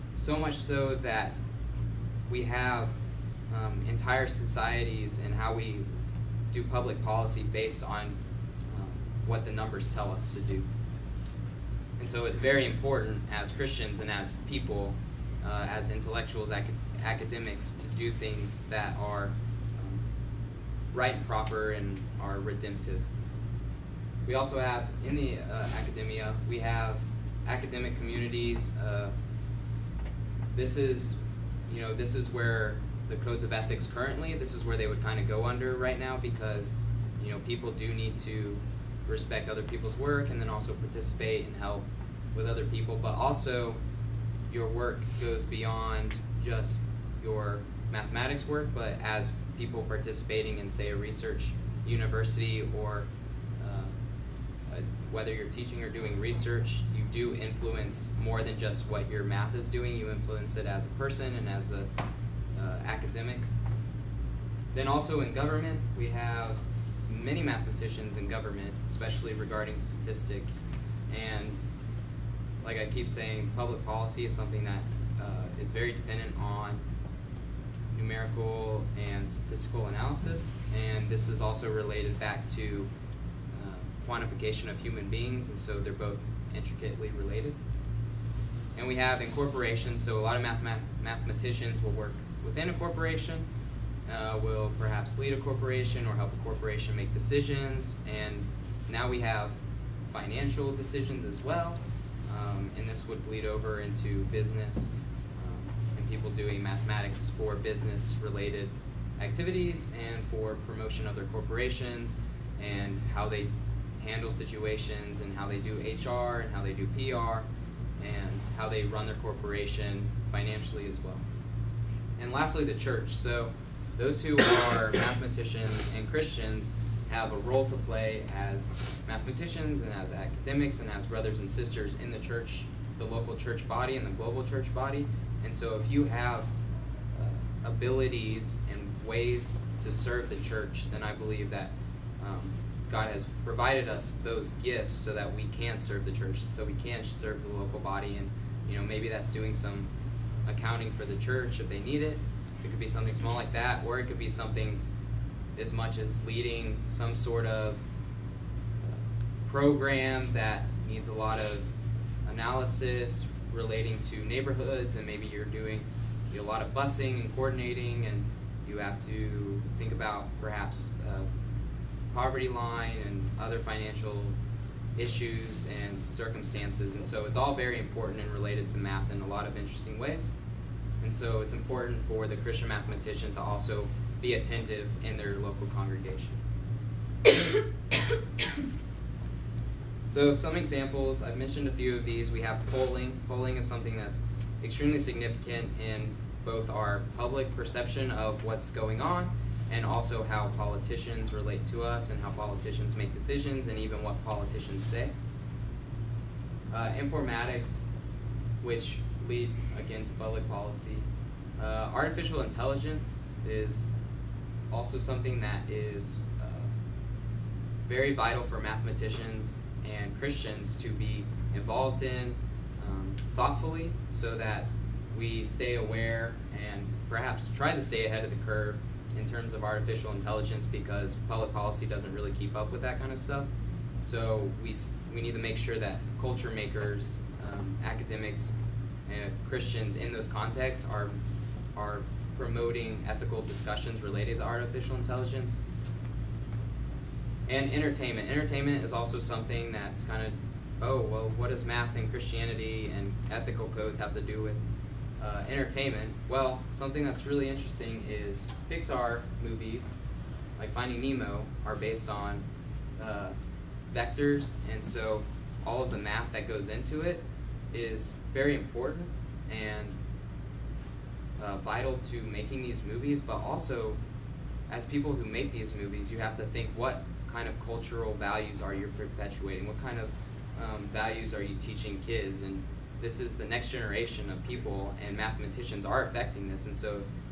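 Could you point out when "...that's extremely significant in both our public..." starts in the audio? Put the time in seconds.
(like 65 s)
193 s.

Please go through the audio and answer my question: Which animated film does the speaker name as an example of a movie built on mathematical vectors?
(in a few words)
Finding Nemo.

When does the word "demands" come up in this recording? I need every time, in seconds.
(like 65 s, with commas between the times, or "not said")
not said.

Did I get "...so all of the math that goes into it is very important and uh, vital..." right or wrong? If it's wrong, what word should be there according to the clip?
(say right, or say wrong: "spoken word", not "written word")
right.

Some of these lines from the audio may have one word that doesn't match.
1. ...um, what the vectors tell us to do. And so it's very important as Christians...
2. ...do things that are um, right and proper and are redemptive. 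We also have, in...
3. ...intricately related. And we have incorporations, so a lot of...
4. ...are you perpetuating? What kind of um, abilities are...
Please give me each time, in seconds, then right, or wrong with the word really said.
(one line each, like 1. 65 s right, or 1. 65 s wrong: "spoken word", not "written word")
1. 8 s wrong: "numbers", not "vectors"
2. 17 s right
3. 86 s right
4. 278 s wrong: "values", not "abilities".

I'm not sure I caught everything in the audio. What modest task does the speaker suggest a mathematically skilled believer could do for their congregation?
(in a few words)
accounting.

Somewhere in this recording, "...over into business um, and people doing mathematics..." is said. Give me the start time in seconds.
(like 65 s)
103 s.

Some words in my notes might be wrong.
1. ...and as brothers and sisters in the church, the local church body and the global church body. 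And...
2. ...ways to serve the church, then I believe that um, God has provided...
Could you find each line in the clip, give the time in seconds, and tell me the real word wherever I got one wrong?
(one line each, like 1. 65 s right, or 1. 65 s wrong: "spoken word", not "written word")
1. 130 s right
2. 139 s right.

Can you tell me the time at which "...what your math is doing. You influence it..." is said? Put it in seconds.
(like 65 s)
58 s.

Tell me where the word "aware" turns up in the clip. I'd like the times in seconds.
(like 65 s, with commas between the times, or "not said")
225 s.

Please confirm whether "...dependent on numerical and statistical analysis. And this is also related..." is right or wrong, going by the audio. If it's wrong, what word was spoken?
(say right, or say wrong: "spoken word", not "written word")
right.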